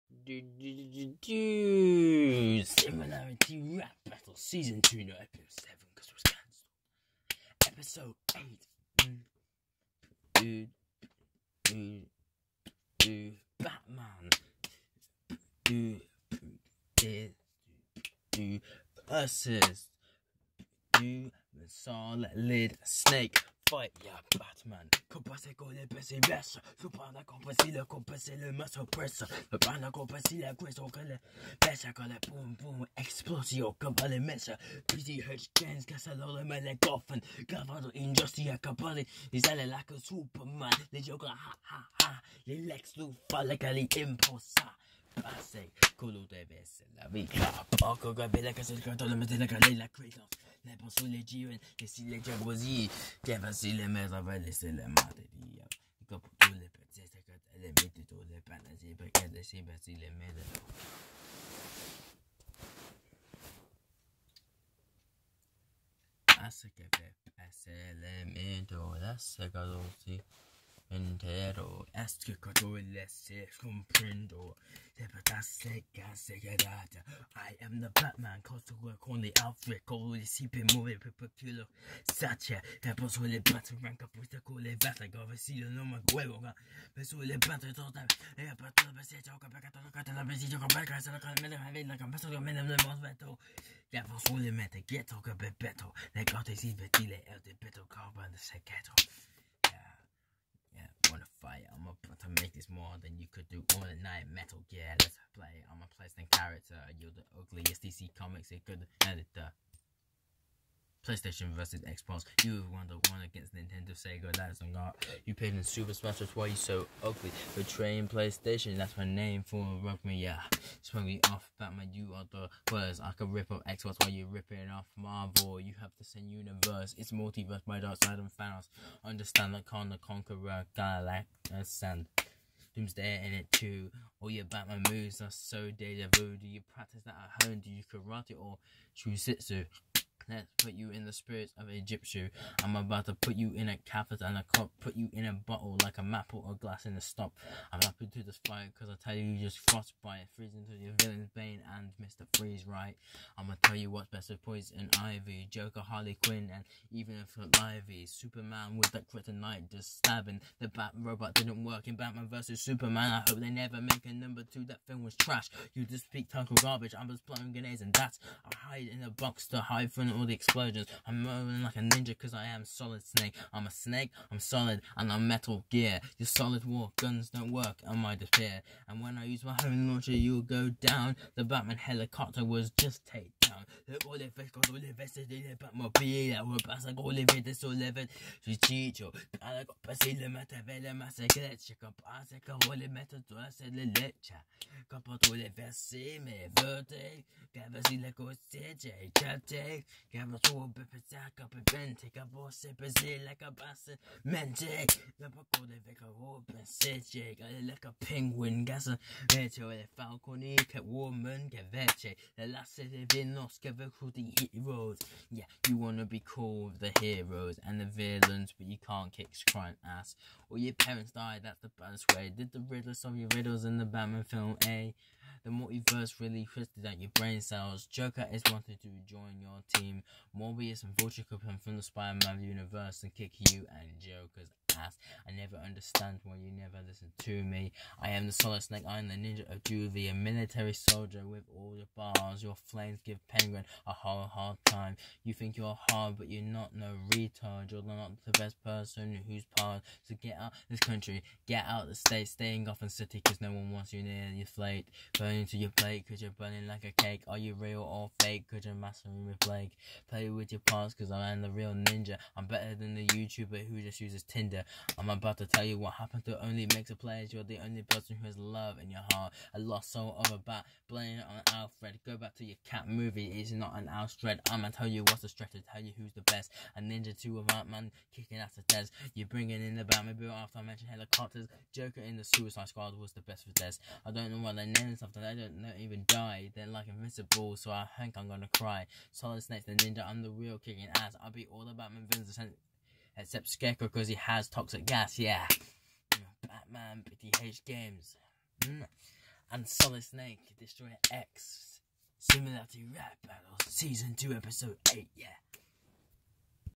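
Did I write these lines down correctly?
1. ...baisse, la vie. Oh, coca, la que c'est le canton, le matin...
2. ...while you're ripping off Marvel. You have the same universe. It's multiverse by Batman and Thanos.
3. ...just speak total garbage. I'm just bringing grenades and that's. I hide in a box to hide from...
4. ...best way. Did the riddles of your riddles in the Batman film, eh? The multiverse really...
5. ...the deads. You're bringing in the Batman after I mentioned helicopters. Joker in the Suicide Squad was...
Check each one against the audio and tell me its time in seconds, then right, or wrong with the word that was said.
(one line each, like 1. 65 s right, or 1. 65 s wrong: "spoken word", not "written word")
1. 46 s right
2. 124 s wrong: "Darkseid", not "Batman"
3. 165 s wrong: "blowing", not "bringing"
4. 221 s right
5. 278 s right.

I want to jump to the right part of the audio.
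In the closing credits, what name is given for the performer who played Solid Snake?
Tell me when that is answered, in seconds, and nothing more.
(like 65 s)
300 s.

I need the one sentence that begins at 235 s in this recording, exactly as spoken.
I never understand why you never listen to me.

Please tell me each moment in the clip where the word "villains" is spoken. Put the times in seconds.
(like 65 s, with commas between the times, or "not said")
151 s, 217 s, 292 s.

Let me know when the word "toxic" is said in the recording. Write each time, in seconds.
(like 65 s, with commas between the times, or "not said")
294 s.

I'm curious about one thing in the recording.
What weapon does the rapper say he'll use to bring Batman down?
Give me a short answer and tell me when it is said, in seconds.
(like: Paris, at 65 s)
home launcher, at 179 s.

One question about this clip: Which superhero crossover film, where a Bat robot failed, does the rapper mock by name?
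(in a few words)
Batman vs. Superman.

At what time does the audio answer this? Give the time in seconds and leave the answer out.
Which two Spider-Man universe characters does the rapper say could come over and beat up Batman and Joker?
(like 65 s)
230 s.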